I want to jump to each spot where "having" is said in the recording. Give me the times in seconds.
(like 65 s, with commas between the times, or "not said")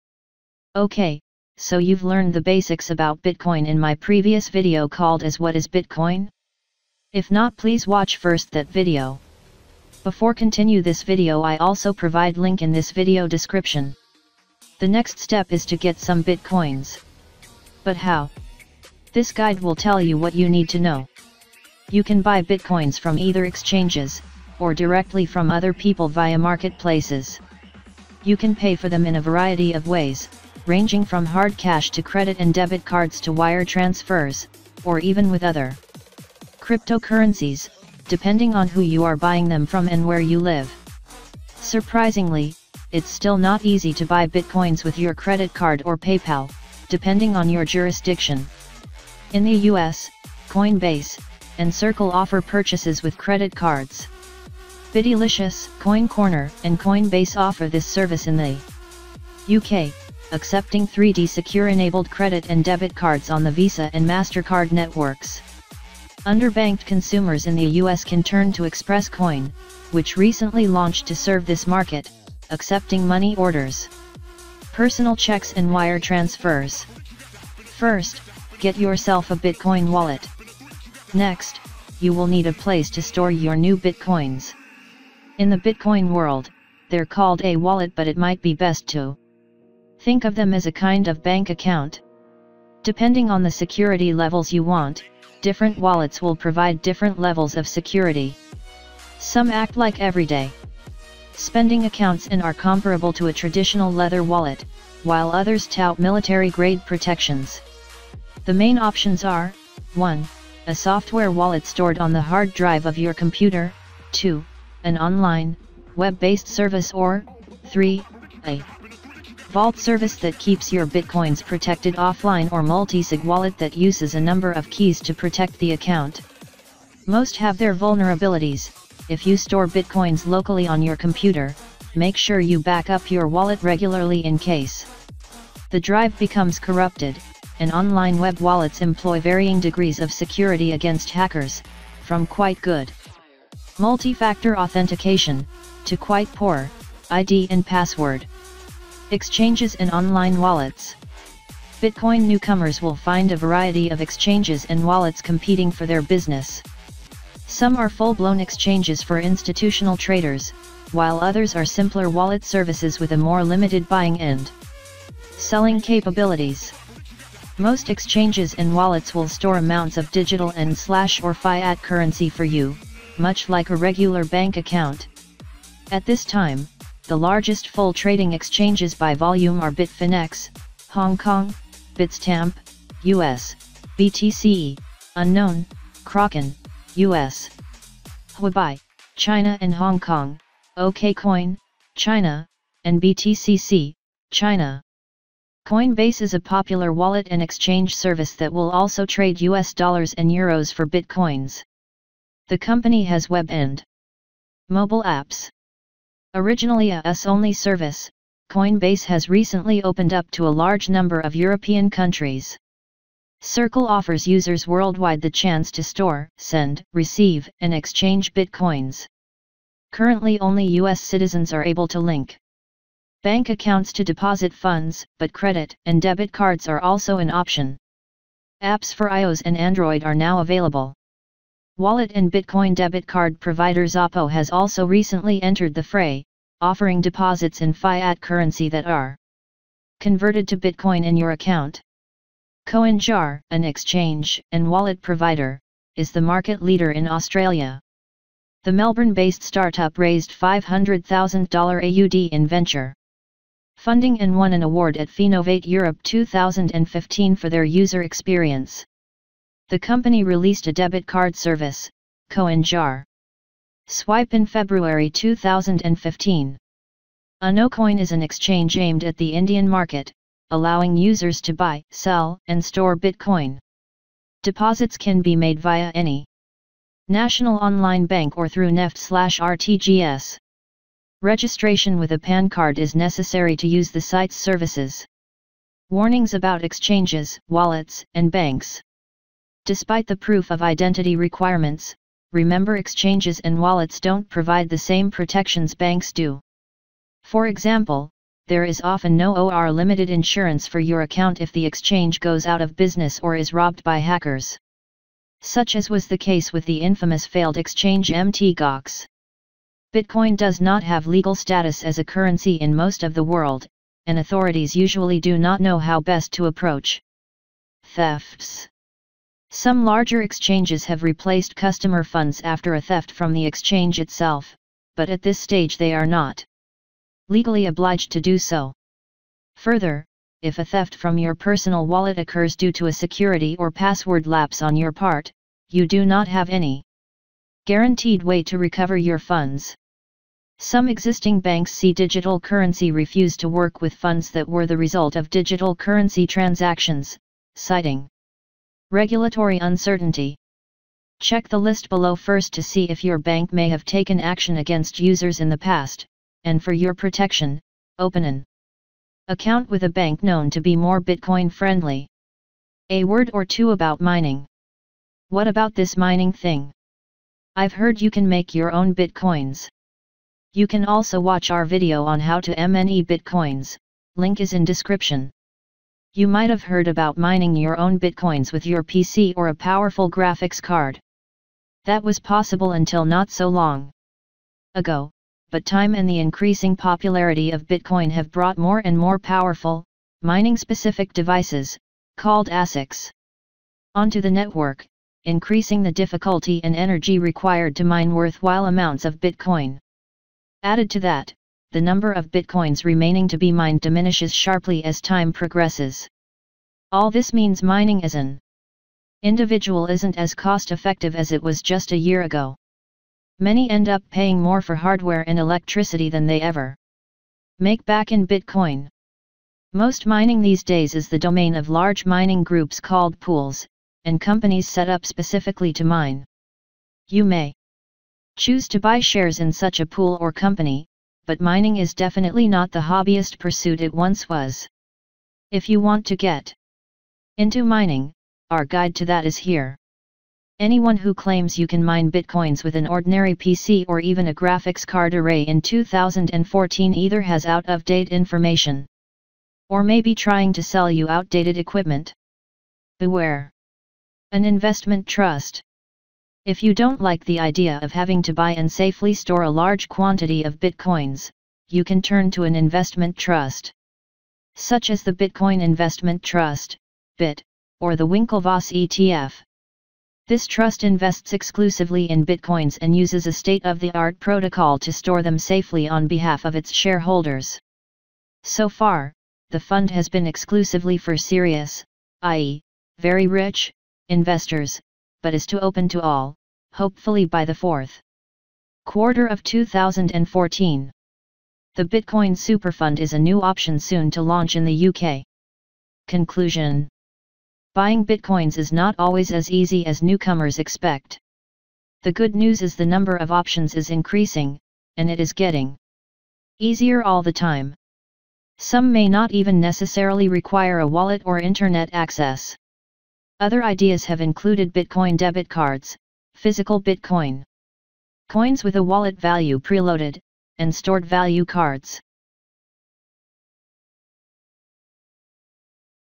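457 s.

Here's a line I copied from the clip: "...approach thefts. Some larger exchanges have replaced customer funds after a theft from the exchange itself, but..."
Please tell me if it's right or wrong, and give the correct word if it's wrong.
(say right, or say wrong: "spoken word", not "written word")
right.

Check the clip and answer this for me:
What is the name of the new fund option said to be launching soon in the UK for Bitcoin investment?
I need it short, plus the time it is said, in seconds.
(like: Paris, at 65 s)
Bitcoin Superfund, at 491 s.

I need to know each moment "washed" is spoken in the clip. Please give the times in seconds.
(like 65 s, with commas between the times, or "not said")
not said.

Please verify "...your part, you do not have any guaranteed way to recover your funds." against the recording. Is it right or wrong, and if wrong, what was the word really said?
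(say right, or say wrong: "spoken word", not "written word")
right.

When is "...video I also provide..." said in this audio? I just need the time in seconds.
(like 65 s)
11 s.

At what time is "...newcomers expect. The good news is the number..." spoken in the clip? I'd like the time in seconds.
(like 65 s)
500 s.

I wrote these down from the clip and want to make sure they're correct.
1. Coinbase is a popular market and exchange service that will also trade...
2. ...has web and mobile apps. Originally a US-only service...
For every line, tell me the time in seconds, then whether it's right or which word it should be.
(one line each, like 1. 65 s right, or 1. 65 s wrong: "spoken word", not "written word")
1. 195 s wrong: "wallet", not "market"
2. 203 s right.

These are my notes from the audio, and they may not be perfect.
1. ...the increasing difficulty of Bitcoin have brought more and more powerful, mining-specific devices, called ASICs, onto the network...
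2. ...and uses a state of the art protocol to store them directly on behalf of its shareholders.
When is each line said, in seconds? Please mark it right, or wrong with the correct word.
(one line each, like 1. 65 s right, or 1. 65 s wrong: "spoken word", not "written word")
1. 386 s wrong: "popularity", not "difficulty"
2. 472 s wrong: "safely", not "directly".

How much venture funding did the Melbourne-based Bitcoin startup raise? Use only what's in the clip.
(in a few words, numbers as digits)
$500,000 AUD.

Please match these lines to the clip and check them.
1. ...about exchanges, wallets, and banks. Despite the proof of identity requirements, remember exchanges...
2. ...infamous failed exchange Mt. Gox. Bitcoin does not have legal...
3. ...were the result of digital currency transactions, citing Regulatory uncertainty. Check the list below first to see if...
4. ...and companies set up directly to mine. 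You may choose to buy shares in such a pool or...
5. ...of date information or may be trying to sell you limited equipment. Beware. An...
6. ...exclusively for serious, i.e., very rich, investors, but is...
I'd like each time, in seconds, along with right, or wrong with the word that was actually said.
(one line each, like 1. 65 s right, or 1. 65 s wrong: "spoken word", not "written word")
1. 286 s right
2. 306 s right
3. 344 s right
4. 424 s wrong: "specifically", not "directly"
5. 447 s wrong: "outdated", not "limited"
6. 480 s right.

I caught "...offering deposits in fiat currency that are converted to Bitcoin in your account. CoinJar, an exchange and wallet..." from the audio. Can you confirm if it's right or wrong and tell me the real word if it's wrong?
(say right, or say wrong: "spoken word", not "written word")
right.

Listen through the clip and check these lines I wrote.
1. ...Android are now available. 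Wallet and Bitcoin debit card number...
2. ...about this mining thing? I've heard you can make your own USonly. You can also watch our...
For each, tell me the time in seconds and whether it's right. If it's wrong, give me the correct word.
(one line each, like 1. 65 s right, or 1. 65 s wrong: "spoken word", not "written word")
1. 229 s wrong: "provider", not "number"
2. 365 s wrong: "Bitcoins", not "USonly".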